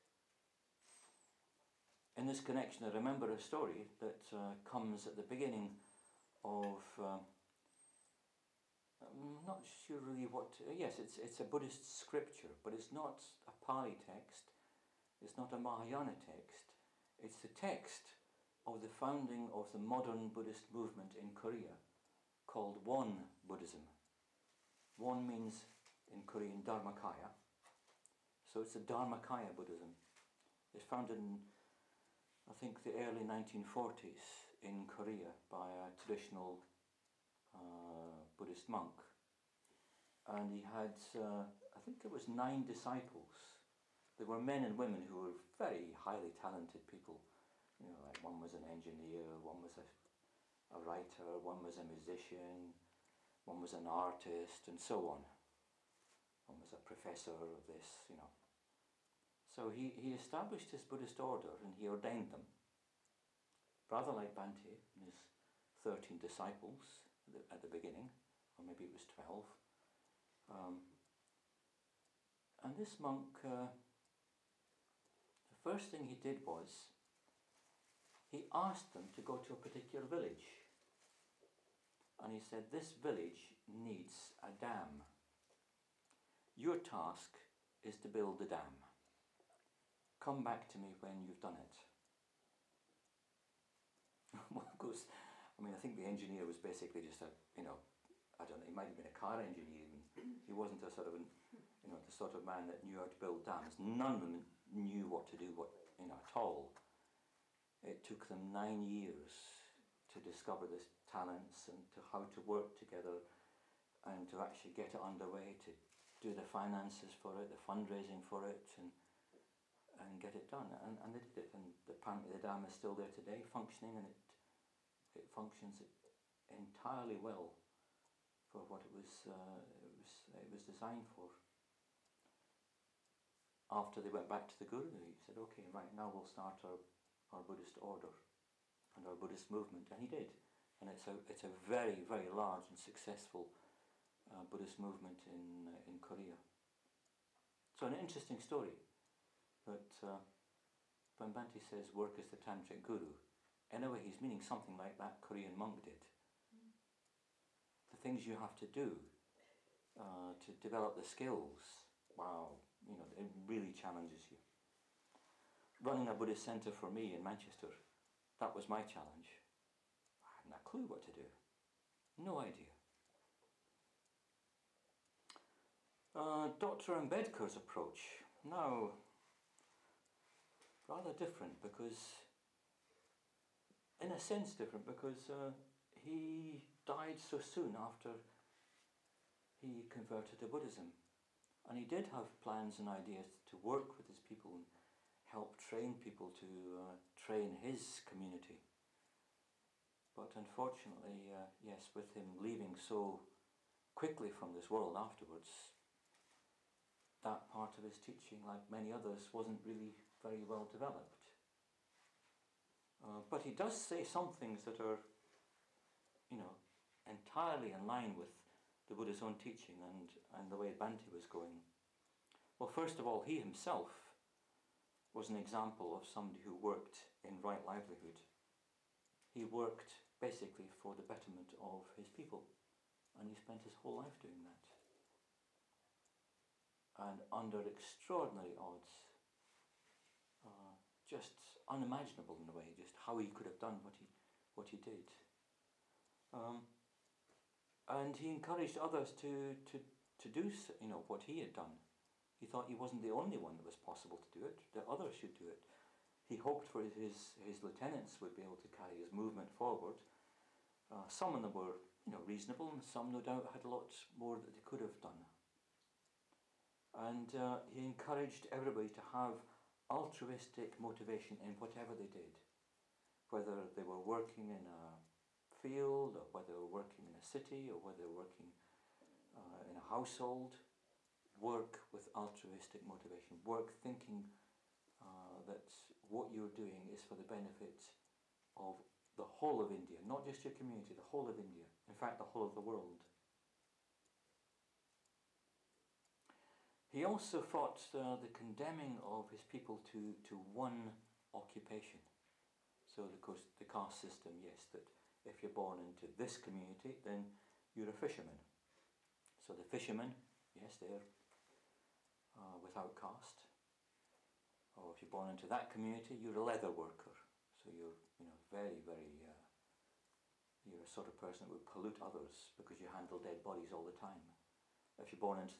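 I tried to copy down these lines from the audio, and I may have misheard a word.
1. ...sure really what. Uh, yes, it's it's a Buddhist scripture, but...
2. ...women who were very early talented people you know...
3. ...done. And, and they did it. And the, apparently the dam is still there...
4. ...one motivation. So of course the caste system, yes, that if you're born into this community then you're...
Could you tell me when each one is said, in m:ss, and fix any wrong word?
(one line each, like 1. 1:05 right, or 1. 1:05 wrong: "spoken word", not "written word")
1. 0:09 right
2. 0:44 wrong: "highly", not "early"
3. 2:00 right
4. 5:00 wrong: "occupation", not "motivation".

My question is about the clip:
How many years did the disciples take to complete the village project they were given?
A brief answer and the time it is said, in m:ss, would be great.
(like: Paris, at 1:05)
9, at 1:48.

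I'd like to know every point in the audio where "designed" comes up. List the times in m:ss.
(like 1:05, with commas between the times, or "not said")
2:10.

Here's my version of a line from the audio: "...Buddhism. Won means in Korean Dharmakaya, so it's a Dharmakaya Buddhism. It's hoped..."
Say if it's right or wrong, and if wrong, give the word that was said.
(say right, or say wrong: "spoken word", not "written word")
wrong: "founded", not "hoped".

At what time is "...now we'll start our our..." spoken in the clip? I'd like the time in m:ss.
2:15.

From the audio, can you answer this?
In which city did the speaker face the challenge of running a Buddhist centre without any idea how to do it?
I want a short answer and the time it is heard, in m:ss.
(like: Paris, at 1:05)
Manchester, at 2:47.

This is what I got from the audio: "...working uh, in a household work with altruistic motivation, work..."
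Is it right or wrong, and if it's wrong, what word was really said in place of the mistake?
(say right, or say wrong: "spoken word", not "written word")
right.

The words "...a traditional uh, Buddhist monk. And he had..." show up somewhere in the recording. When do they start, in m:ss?
0:35.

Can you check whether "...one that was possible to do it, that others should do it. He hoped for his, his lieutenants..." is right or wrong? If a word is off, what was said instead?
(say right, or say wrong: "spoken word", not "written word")
right.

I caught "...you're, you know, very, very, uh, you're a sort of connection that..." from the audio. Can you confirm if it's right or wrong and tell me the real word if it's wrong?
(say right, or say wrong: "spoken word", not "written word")
wrong: "person", not "connection".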